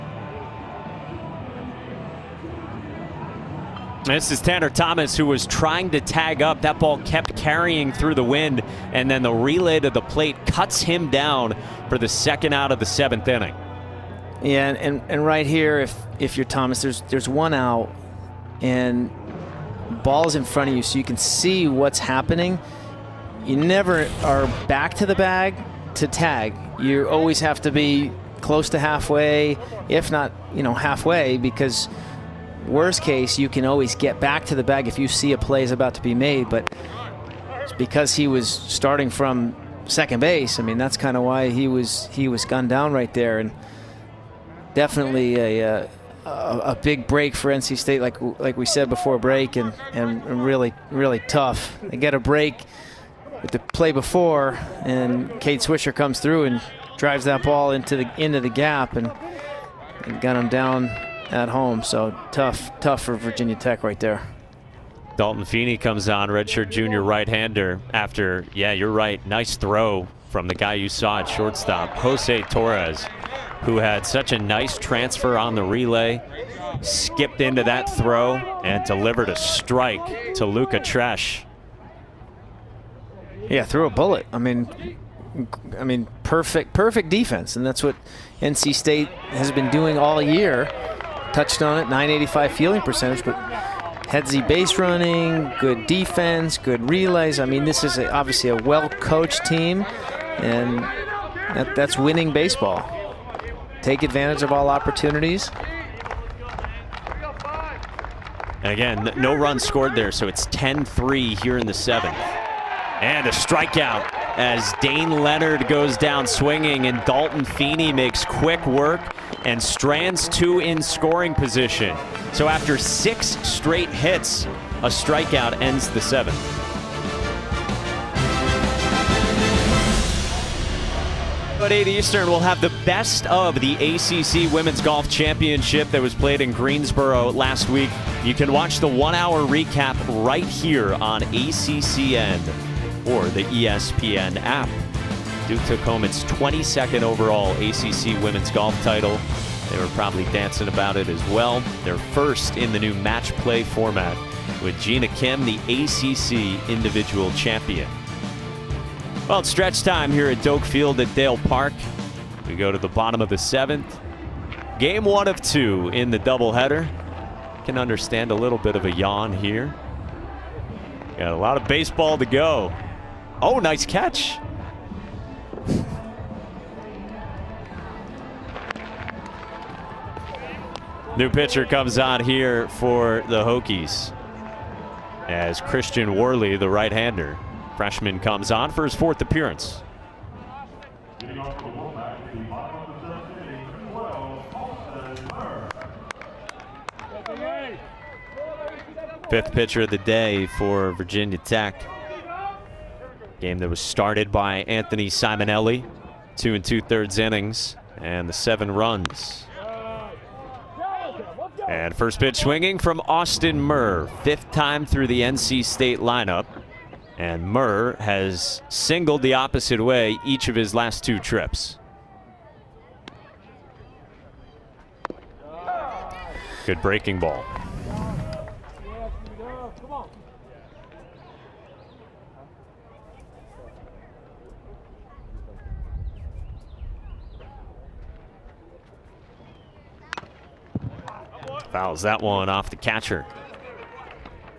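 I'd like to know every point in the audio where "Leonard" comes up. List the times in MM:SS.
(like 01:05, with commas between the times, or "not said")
01:55.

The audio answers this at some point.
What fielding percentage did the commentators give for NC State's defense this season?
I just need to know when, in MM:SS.
01:31.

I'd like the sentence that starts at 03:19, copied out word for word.
Fifth pitcher of the day for Virginia Tech.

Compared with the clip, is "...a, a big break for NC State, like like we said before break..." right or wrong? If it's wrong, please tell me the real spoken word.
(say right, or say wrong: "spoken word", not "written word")
right.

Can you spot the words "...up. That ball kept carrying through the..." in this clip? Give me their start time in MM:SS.
00:06.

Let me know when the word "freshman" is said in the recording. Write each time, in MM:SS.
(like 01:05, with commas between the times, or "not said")
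03:07.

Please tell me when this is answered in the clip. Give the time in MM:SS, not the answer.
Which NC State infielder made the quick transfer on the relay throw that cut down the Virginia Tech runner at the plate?
01:11.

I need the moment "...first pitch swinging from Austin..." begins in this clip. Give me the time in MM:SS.
03:31.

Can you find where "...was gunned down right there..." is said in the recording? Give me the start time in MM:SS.
00:42.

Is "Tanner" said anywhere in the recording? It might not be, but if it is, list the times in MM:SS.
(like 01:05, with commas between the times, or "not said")
00:04.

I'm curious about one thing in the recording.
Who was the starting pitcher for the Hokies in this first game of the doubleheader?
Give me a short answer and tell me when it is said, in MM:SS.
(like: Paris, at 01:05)
Anthony Simonelli, at 03:24.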